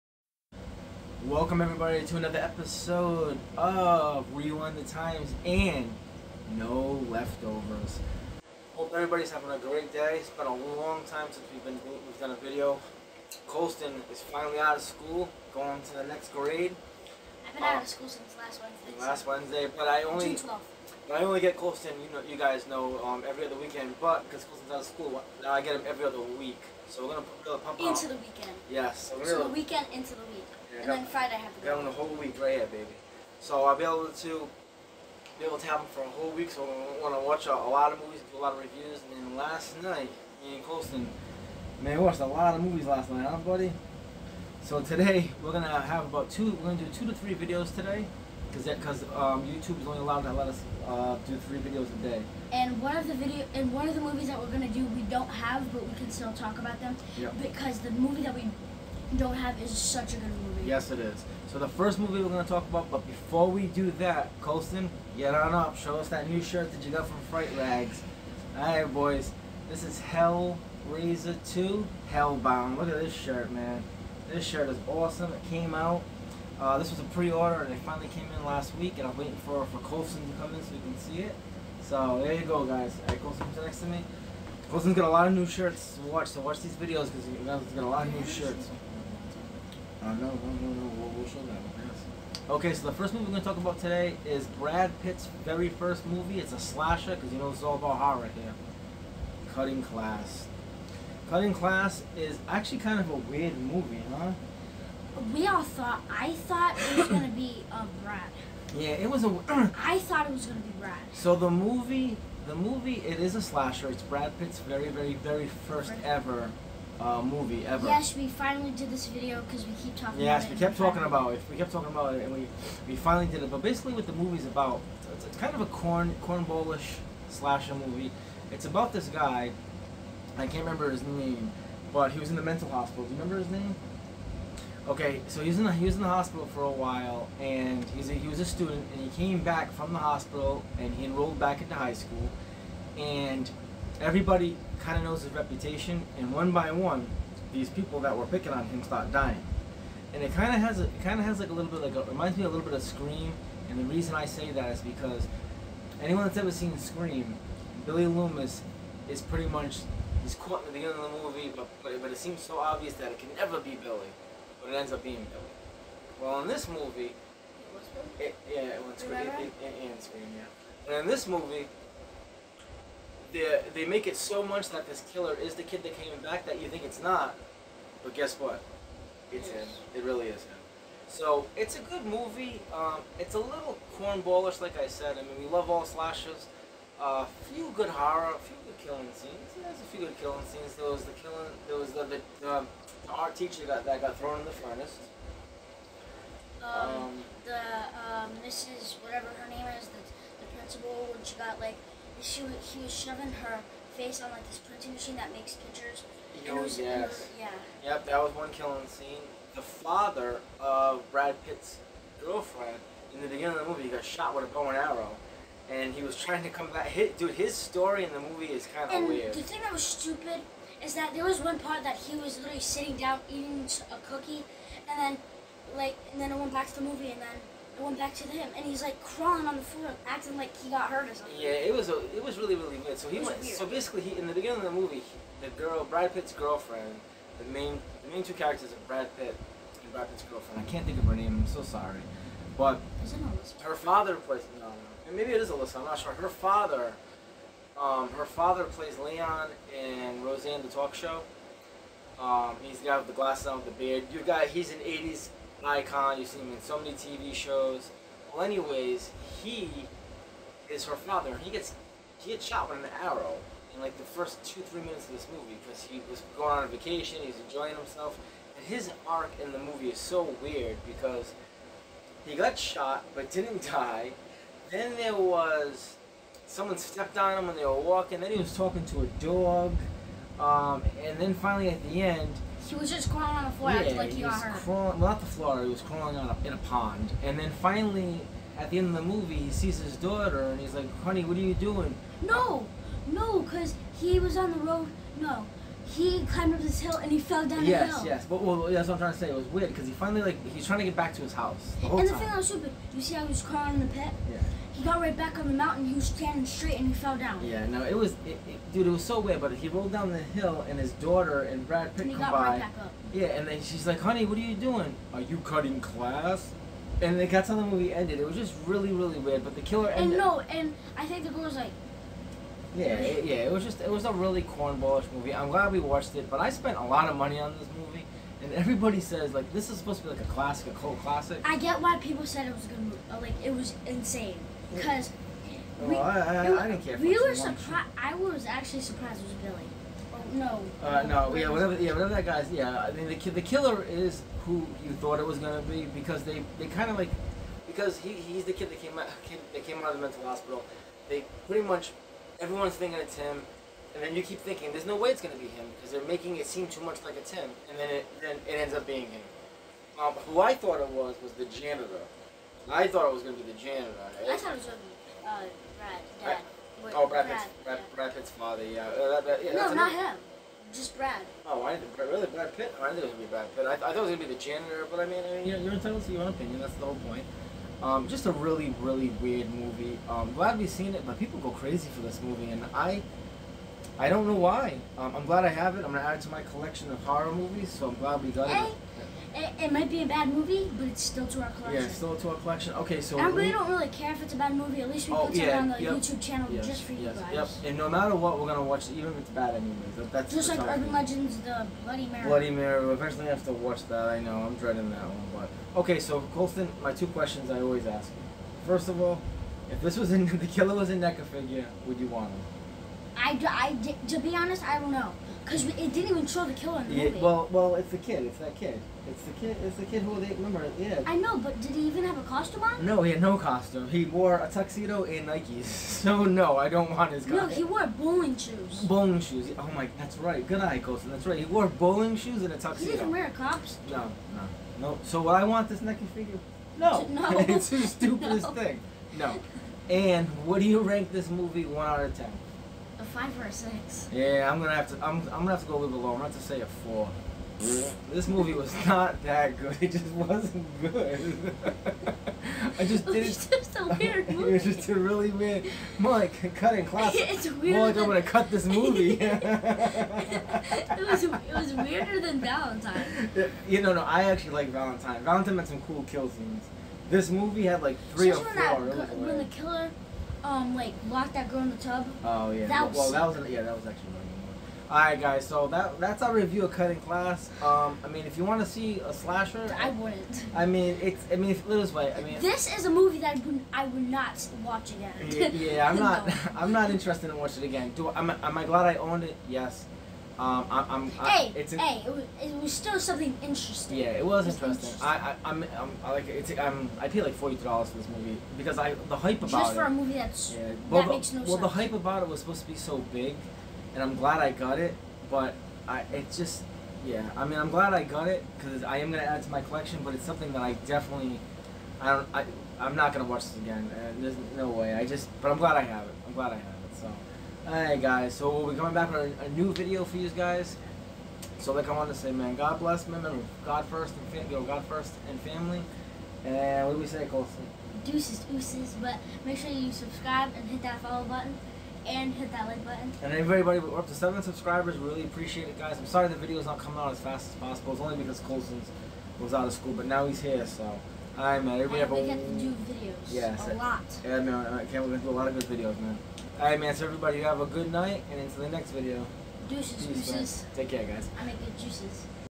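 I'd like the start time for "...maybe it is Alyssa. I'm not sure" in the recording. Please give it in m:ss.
4:05.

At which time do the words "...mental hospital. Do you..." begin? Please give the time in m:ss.
2:12.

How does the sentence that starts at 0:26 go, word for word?
So we're gonna, pump are to pump into out.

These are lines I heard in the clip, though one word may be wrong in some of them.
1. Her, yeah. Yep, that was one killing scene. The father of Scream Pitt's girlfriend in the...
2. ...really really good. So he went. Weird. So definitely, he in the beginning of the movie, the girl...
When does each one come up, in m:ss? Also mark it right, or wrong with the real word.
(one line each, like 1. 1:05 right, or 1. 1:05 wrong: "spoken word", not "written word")
1. 3:27 wrong: "Brad", not "Scream"
2. 3:52 wrong: "basically", not "definitely".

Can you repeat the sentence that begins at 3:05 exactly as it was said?
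I mean, we love all slashes.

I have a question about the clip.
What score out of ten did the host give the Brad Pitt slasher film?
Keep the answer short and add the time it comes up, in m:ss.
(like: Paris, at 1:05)
4, at 7:26.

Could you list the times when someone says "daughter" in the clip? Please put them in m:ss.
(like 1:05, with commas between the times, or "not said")
4:49, 5:10.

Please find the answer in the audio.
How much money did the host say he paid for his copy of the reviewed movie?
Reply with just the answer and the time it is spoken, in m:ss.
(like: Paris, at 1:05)
$40, at 8:17.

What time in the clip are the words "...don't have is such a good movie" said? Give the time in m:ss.
0:59.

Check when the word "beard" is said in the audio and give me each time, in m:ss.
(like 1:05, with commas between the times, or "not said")
4:13.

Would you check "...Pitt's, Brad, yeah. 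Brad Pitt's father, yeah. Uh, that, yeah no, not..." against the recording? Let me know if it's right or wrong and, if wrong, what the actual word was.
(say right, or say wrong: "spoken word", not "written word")
right.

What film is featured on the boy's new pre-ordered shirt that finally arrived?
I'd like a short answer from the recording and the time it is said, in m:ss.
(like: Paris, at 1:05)
Hellraiser 2 Hellbound, at 1:10.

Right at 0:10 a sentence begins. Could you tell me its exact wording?
It's been a long time since we've been we've done a video.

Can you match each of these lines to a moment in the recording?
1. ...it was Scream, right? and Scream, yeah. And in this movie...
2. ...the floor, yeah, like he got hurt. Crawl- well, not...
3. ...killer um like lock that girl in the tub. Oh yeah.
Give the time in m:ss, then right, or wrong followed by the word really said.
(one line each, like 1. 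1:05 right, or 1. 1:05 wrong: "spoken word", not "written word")
1. 2:48 right
2. 4:43 right
3. 7:49 right.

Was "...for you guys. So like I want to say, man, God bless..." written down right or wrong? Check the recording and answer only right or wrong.
right.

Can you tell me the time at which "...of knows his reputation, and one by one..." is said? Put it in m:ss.
2:24.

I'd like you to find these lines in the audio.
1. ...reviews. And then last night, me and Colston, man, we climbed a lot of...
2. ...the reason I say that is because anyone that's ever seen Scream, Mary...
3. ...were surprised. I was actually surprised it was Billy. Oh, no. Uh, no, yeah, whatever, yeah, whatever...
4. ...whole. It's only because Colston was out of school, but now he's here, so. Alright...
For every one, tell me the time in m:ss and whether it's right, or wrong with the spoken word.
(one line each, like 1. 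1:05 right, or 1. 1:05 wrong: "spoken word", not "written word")
1. 0:38 wrong: "watched", not "climbed"
2. 2:33 wrong: "Billy", not "Mary"
3. 5:37 right
4. 8:57 wrong: "possible", not "whole".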